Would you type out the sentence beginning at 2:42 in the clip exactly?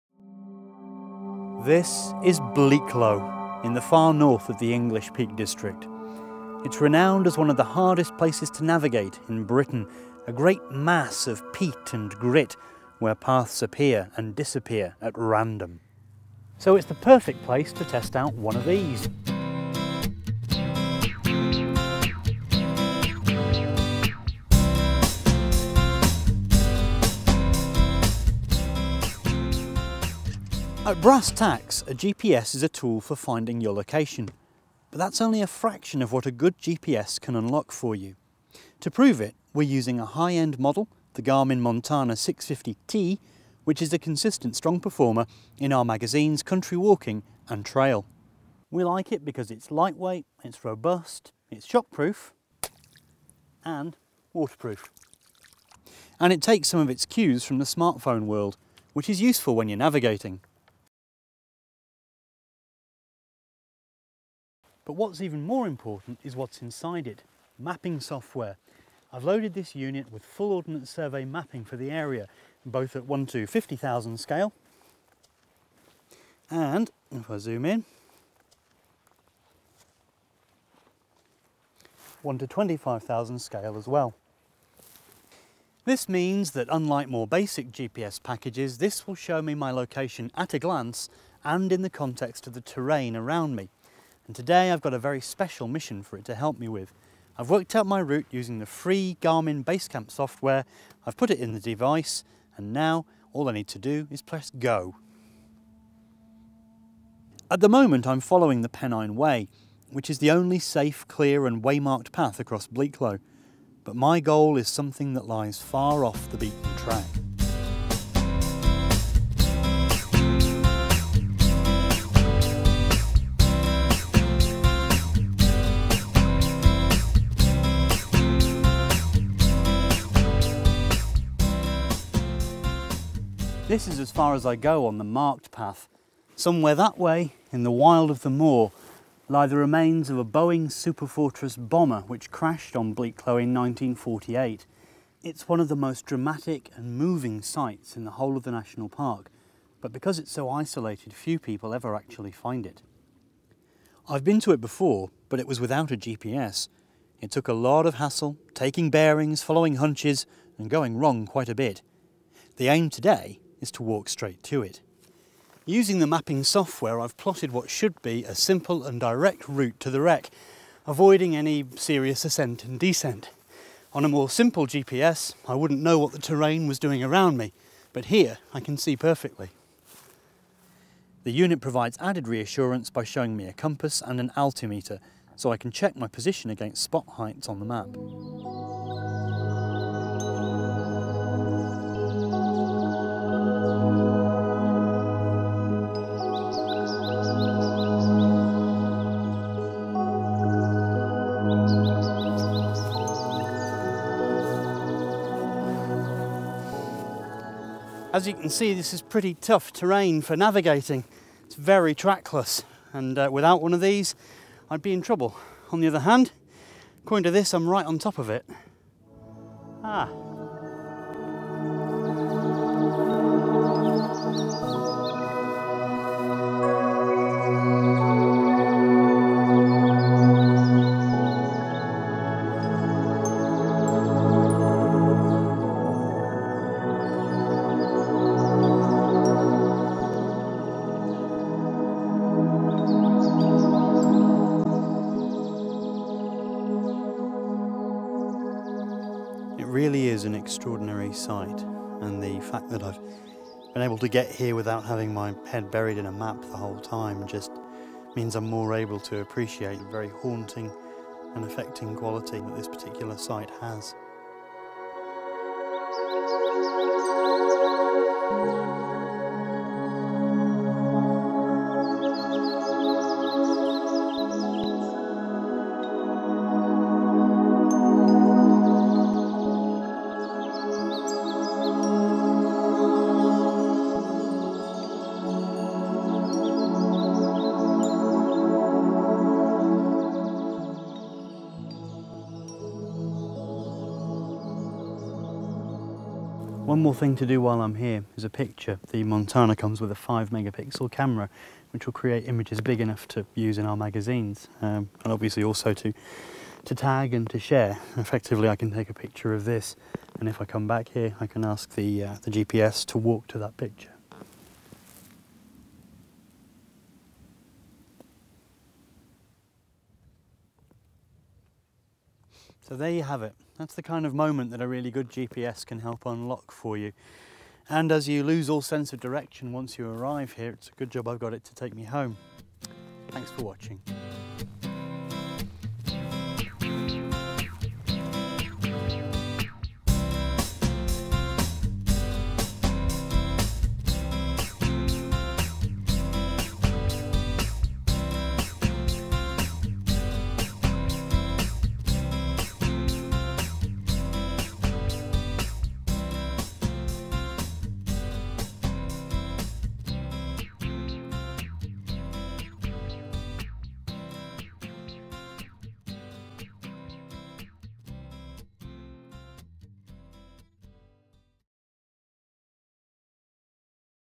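The aim today is to walk straight to it.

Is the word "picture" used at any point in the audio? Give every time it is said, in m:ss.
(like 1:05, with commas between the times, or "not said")
4:58, 5:08, 5:13.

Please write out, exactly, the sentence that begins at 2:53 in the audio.
On a more simple GPS, I wouldn't know what the terrain was doing around me, but here I can see perfectly.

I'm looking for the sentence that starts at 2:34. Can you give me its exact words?
I've been to it before, but it was without a GPS.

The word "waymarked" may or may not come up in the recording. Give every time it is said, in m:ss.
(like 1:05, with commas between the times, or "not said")
1:51.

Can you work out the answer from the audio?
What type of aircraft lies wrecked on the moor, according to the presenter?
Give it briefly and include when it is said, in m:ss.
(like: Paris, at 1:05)
Boeing Superfortress bomber, at 2:20.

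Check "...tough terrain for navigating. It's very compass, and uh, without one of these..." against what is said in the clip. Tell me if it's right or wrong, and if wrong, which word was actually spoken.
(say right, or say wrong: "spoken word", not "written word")
wrong: "trackless", not "compass".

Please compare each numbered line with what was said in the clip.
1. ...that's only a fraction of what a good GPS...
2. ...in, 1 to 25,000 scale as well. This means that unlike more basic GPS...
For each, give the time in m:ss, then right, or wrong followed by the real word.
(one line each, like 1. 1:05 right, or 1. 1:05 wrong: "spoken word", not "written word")
1. 0:34 right
2. 1:17 right.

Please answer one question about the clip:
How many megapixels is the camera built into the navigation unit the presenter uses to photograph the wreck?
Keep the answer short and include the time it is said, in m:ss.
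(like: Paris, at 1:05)
5, at 4:59.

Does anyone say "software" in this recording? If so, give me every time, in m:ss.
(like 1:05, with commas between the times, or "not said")
1:07, 1:40, 2:46.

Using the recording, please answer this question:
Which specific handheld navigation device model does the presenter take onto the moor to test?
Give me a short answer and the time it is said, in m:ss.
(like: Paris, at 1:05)
Garmin Montana 650T, at 0:41.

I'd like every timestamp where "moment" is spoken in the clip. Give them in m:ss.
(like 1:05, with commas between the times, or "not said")
1:47, 5:24.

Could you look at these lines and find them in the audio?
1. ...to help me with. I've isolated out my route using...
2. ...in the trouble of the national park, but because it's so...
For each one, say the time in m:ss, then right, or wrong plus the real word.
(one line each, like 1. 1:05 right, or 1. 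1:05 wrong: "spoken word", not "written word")
1. 1:36 wrong: "worked", not "isolated"
2. 2:27 wrong: "whole", not "trouble".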